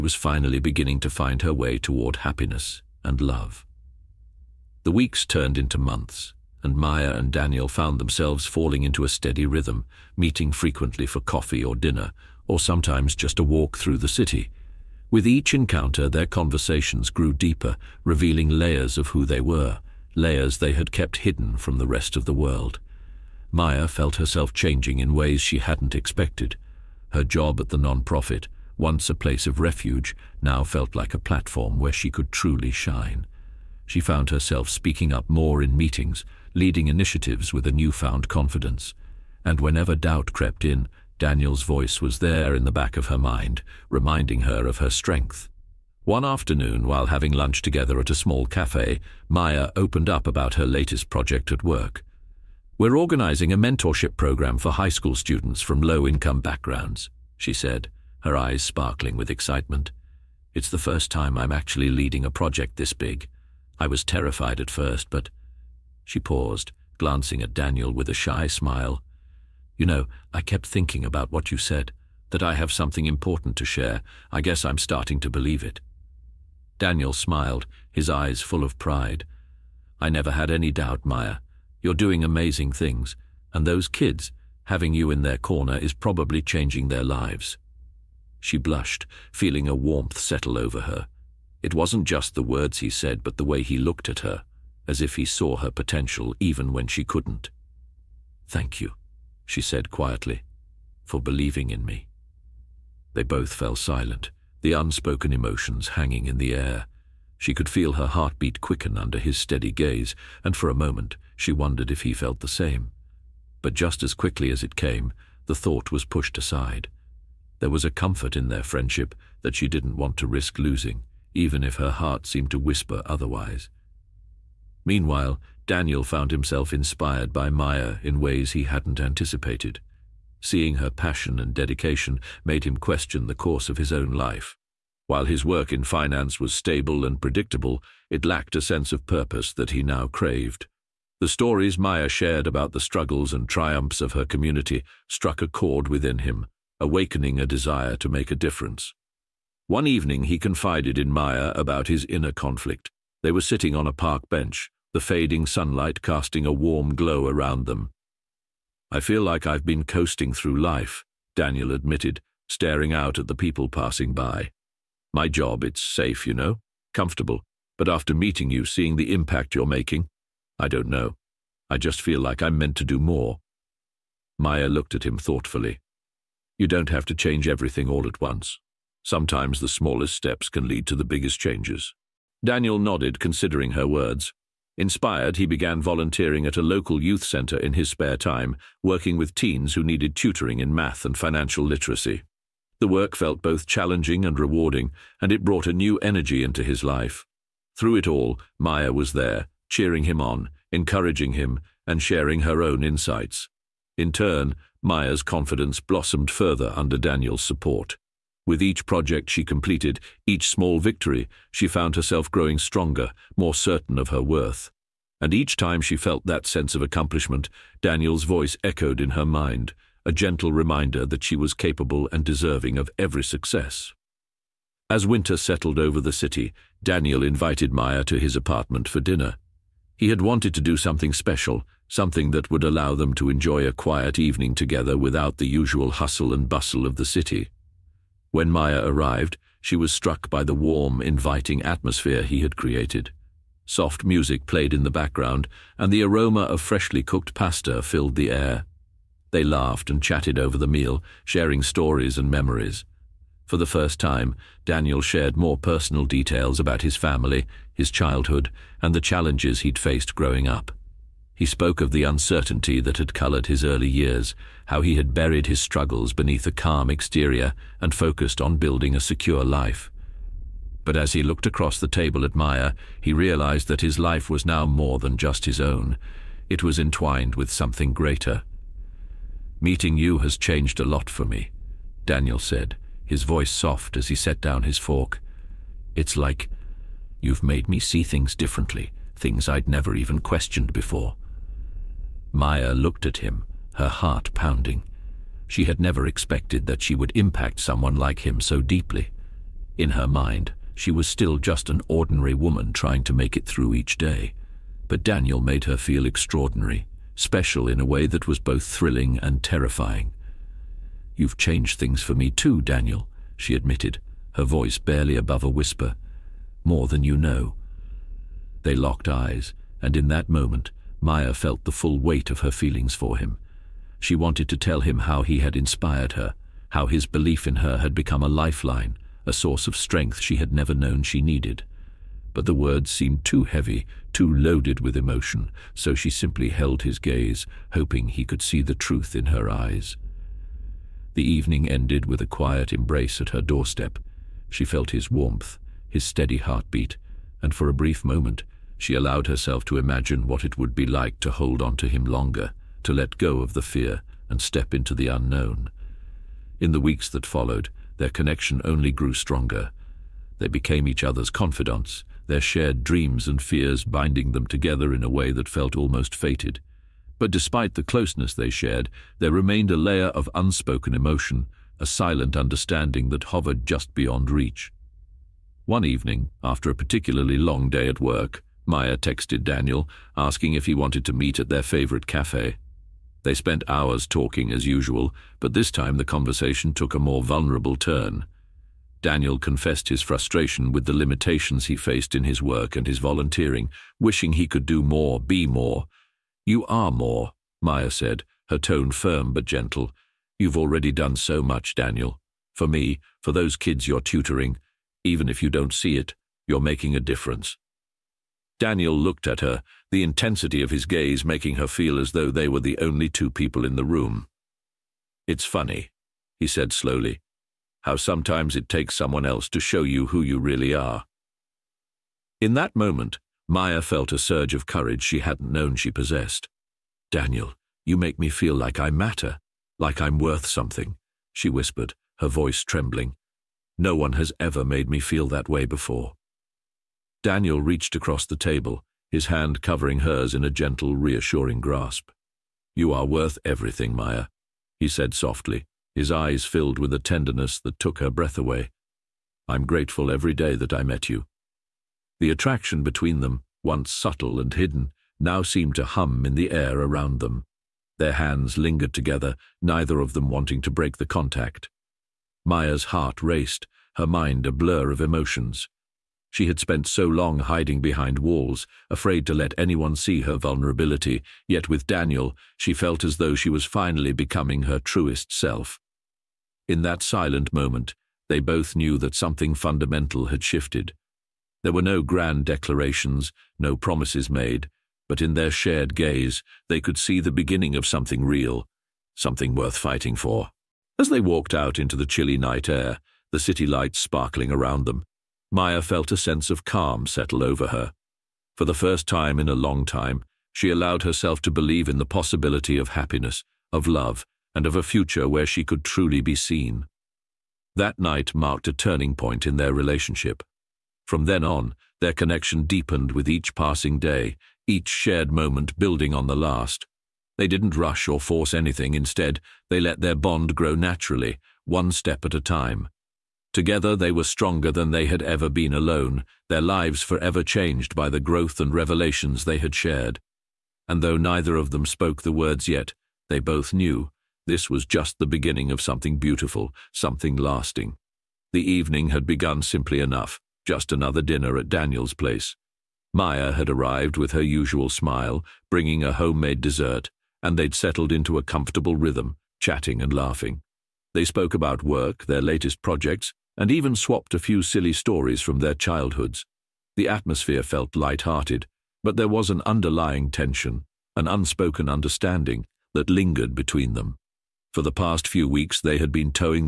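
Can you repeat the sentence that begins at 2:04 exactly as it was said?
Meanwhile, Daniel found himself inspired by Maya in ways he hadn't anticipated.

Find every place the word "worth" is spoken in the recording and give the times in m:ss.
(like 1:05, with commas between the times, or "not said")
3:34, 7:10, 7:23, 8:09.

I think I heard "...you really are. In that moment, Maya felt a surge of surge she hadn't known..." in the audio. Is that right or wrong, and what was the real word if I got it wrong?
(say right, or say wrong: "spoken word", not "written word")
wrong: "courage", not "surge".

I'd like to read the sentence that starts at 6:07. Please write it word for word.
But despite the closeness they shared, there remained a layer of unspoken emotion, a silent understanding that hovered just beyond reach.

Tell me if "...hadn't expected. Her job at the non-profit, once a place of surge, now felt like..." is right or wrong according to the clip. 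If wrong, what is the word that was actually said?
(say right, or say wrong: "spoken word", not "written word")
wrong: "refuge", not "surge".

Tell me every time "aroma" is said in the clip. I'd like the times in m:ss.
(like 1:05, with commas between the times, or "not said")
4:06.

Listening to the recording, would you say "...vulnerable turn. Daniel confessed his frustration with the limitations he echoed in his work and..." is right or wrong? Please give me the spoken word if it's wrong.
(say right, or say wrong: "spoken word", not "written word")
wrong: "faced", not "echoed".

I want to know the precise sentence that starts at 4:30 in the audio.
But as he looked across the table at Maya, he realized that his life was now more than just his own.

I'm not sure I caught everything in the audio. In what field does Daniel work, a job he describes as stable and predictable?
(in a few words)
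Finance.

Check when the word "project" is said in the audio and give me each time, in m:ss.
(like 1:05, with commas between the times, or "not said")
0:51, 1:02, 3:28, 9:12.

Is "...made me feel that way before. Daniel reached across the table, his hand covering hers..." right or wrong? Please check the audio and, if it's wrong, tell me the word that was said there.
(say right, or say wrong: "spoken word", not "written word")
right.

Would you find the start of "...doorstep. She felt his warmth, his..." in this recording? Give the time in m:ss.
5:43.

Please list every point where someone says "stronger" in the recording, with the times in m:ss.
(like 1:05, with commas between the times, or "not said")
3:32, 5:59, 8:44.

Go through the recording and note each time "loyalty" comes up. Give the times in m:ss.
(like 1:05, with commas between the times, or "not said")
not said.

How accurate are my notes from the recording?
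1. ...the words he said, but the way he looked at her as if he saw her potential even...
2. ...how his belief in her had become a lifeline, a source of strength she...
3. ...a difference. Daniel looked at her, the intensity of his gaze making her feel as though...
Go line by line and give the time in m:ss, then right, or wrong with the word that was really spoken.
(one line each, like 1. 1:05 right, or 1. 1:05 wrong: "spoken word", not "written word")
1. 1:32 right
2. 5:26 right
3. 6:46 right.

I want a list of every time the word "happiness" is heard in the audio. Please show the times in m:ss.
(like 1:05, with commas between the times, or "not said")
0:02, 8:22.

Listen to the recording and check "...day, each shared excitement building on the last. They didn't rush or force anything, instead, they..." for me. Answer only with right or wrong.
wrong.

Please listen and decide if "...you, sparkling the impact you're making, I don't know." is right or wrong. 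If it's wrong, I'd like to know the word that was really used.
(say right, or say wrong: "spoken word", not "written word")
wrong: "seeing", not "sparkling".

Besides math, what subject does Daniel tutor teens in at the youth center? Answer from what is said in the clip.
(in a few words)
Financial literacy.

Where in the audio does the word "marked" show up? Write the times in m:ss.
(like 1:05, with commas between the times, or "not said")
8:28.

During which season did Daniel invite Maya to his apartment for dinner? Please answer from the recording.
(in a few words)
Winter.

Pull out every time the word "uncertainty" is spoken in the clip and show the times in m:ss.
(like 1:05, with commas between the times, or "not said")
4:22.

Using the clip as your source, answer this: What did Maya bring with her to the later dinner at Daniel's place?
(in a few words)
A homemade dessert.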